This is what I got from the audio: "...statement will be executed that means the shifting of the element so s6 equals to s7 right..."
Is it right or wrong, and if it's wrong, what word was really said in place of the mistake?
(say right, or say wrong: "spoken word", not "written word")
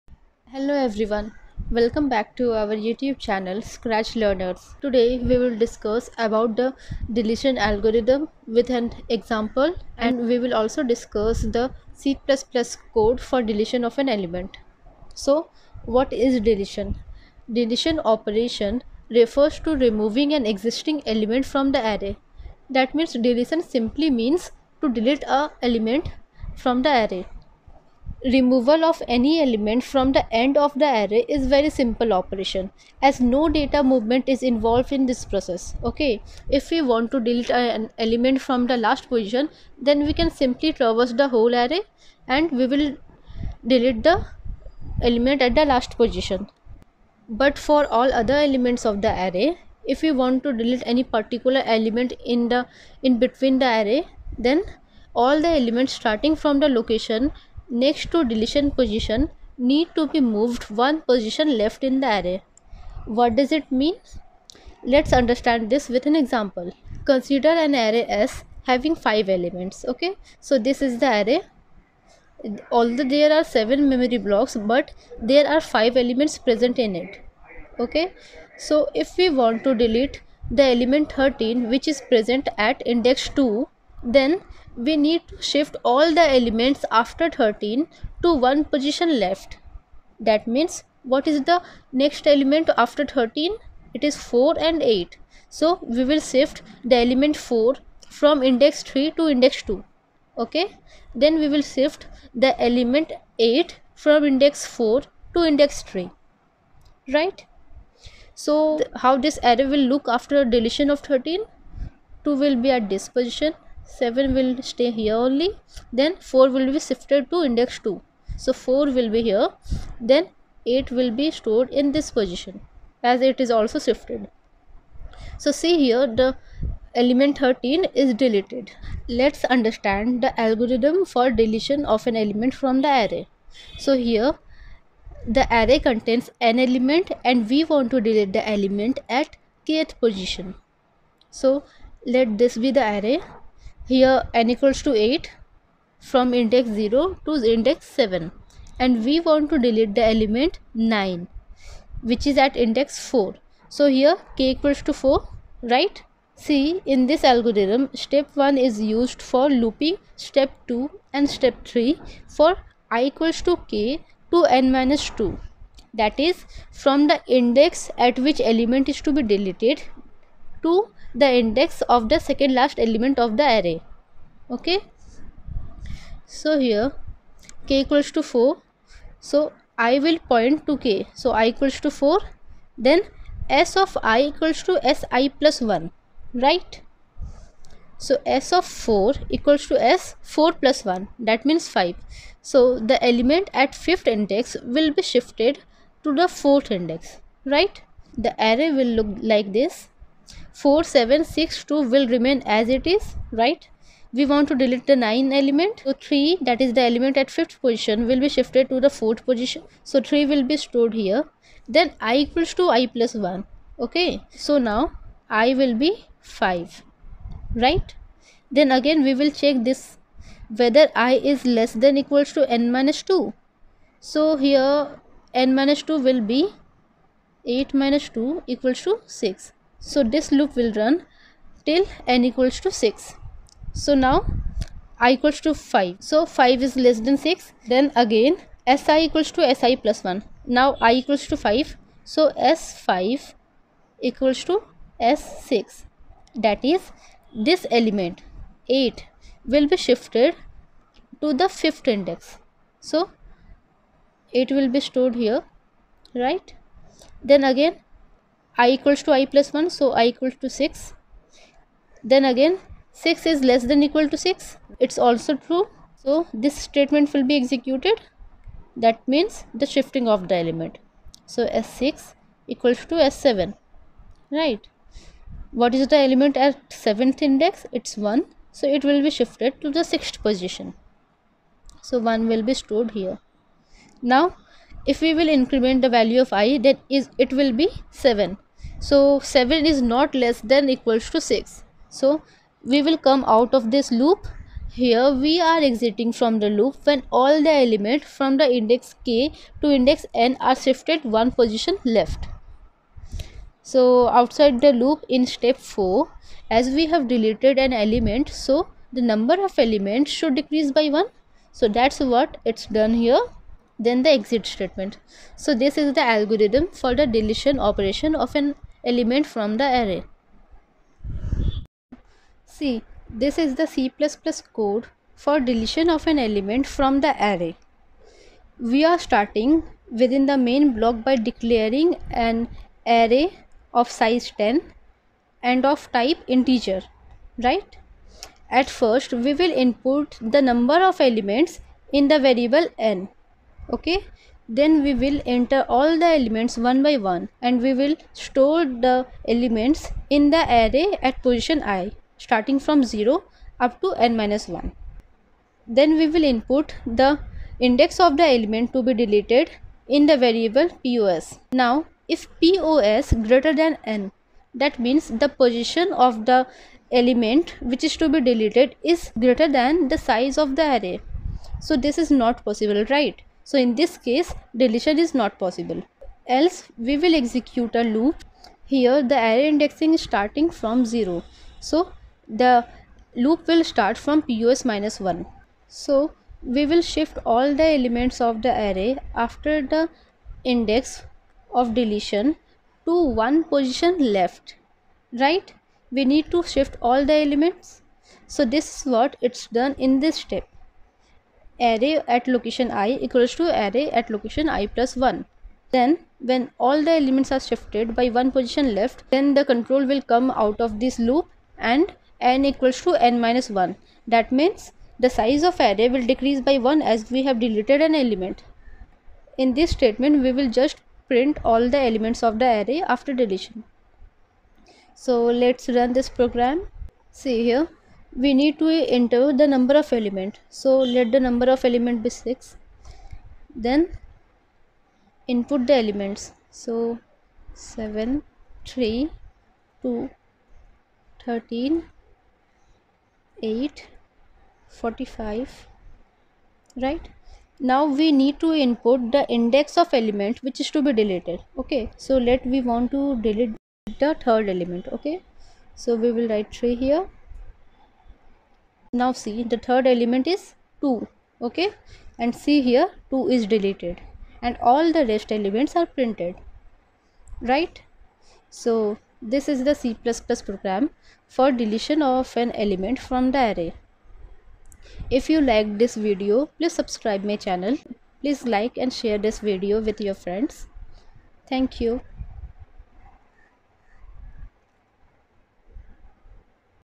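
right.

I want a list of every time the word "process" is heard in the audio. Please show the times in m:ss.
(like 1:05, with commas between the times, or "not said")
0:35.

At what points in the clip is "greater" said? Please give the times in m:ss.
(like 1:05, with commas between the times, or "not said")
6:03, 6:09.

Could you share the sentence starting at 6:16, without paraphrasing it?
Else we will execute a loop.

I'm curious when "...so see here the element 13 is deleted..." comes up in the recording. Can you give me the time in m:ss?
2:05.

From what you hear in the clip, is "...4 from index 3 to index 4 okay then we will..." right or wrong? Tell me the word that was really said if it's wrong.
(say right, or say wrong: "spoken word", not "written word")
wrong: "2", not "4".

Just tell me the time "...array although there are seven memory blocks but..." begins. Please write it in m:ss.
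1:11.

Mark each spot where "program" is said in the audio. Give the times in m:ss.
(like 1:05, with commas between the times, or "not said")
7:06, 7:50.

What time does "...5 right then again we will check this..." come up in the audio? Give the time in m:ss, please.
3:36.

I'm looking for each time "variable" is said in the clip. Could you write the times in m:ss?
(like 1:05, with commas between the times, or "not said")
5:42, 6:00.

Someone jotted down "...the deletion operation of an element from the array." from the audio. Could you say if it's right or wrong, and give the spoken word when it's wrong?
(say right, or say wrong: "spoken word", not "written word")
right.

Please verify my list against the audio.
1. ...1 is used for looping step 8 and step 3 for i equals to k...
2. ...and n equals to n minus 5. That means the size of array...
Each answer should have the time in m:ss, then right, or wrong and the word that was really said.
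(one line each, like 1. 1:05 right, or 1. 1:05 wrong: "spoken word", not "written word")
1. 2:38 wrong: "2", not "8"
2. 6:51 wrong: "1", not "5".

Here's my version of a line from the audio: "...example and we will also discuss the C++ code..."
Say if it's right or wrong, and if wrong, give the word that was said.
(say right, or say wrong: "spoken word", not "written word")
right.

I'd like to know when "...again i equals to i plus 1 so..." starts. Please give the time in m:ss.
4:17.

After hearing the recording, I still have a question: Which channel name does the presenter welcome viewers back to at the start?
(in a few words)
Scratch Learners.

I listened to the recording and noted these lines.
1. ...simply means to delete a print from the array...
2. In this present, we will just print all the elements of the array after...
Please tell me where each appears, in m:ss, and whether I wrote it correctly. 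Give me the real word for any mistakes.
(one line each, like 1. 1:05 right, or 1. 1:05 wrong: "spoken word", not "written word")
1. 0:23 wrong: "element", not "print"
2. 6:59 wrong: "statement", not "present".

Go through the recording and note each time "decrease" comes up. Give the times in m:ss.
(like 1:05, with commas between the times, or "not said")
5:10, 6:56.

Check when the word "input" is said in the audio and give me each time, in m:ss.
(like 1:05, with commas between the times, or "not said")
5:39, 5:56, 7:15, 7:28.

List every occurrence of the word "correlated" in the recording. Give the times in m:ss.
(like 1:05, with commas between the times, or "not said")
not said.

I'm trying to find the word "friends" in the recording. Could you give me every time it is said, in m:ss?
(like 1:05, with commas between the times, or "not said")
8:00.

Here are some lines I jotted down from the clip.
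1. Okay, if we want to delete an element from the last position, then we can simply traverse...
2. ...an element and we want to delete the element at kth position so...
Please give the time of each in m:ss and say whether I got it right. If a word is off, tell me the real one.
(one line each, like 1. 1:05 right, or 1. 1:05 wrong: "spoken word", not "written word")
1. 0:35 right
2. 2:16 right.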